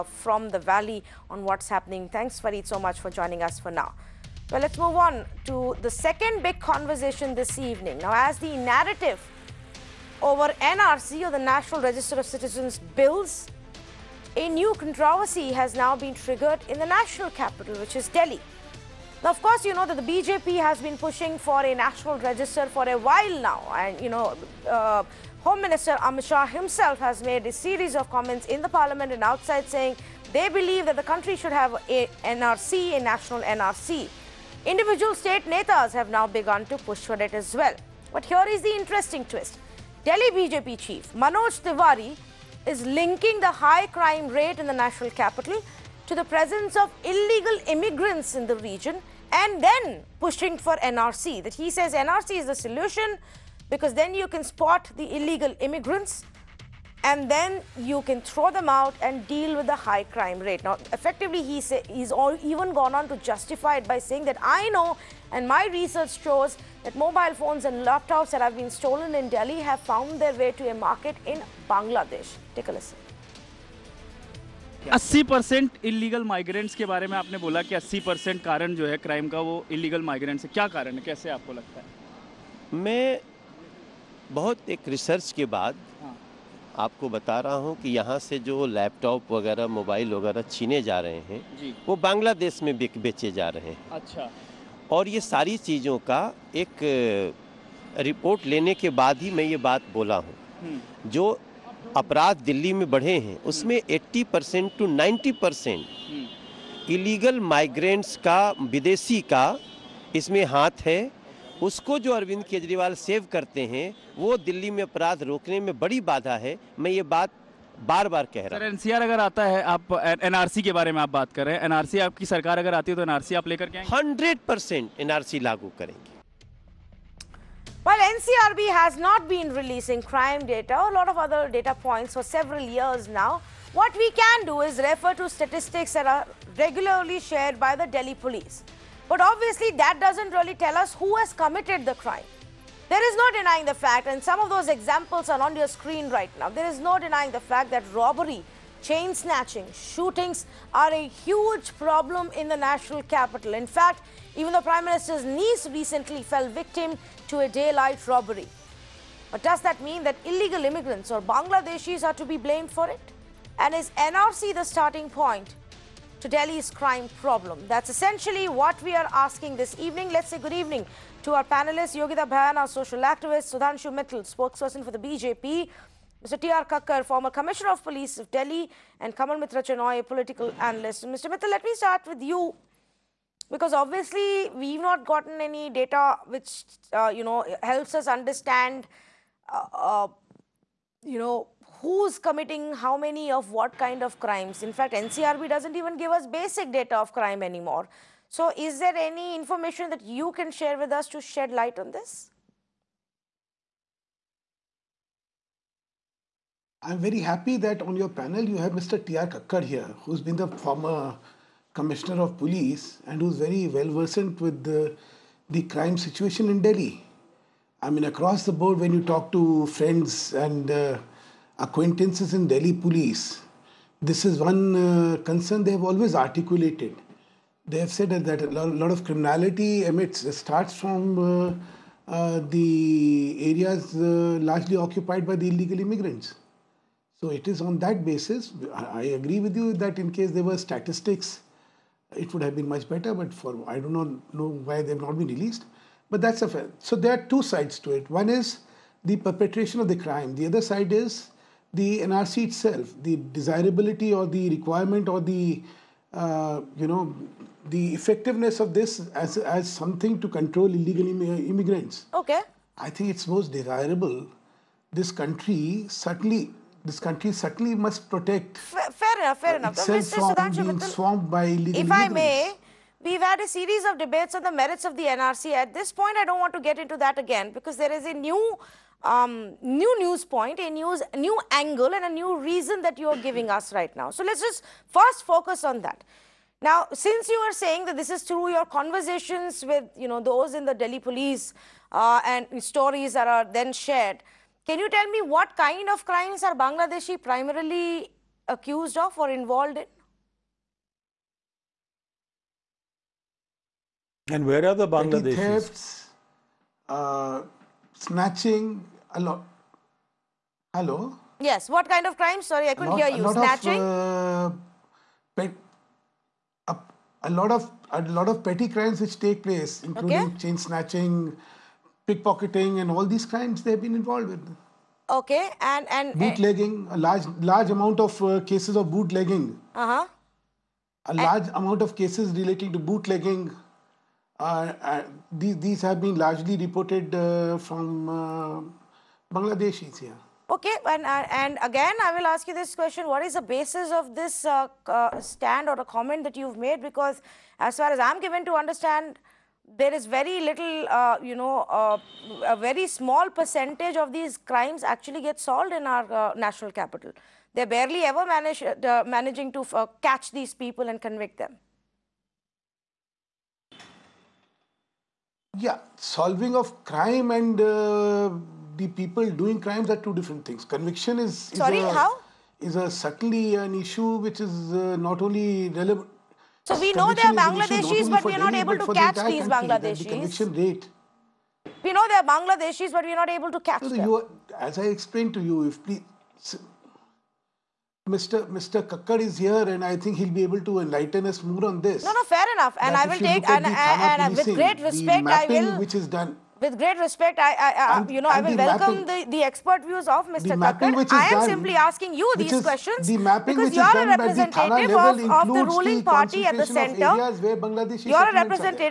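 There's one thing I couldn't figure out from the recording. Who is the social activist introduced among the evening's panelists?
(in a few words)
Yogita Bhayana.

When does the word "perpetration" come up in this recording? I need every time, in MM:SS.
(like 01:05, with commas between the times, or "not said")
04:09.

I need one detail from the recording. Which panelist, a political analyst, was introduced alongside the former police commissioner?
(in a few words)
Kamal Mitra Chenoy.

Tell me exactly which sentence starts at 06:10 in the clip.
Conviction is, is sorry a, how is a subtly an issue which is uh, not only relevant.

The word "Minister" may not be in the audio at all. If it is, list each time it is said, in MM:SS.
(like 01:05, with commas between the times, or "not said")
00:25, 02:34.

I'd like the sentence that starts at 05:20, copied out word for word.
chain snatching, pickpocketing, and all these crimes they've been involved with.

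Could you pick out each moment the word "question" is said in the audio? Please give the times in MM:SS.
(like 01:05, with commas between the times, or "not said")
05:42, 06:42.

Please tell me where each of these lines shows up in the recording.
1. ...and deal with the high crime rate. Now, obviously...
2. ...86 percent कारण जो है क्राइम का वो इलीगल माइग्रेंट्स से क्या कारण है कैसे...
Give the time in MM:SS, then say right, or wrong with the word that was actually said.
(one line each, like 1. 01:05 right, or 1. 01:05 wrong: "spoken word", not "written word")
1. 00:59 wrong: "effectively", not "obviously"
2. 01:17 wrong: "80", not "86".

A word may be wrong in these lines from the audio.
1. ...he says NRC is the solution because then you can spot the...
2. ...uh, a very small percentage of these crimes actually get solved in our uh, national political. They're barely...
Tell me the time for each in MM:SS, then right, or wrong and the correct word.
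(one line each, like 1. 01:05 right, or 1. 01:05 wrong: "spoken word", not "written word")
1. 00:51 right
2. 05:51 wrong: "capital", not "political".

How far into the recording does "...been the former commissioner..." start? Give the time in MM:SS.
03:30.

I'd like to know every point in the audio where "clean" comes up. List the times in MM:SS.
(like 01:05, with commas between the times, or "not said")
not said.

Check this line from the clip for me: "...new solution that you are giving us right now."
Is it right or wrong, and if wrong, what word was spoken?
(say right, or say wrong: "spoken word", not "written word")
wrong: "reason", not "solution".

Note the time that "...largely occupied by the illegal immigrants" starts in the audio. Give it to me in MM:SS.
03:54.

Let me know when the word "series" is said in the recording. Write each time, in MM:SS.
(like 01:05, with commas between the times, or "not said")
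00:27, 04:33.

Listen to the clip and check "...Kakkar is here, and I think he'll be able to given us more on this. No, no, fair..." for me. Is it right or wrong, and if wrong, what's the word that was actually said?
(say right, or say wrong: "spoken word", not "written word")
wrong: "enlighten", not "given".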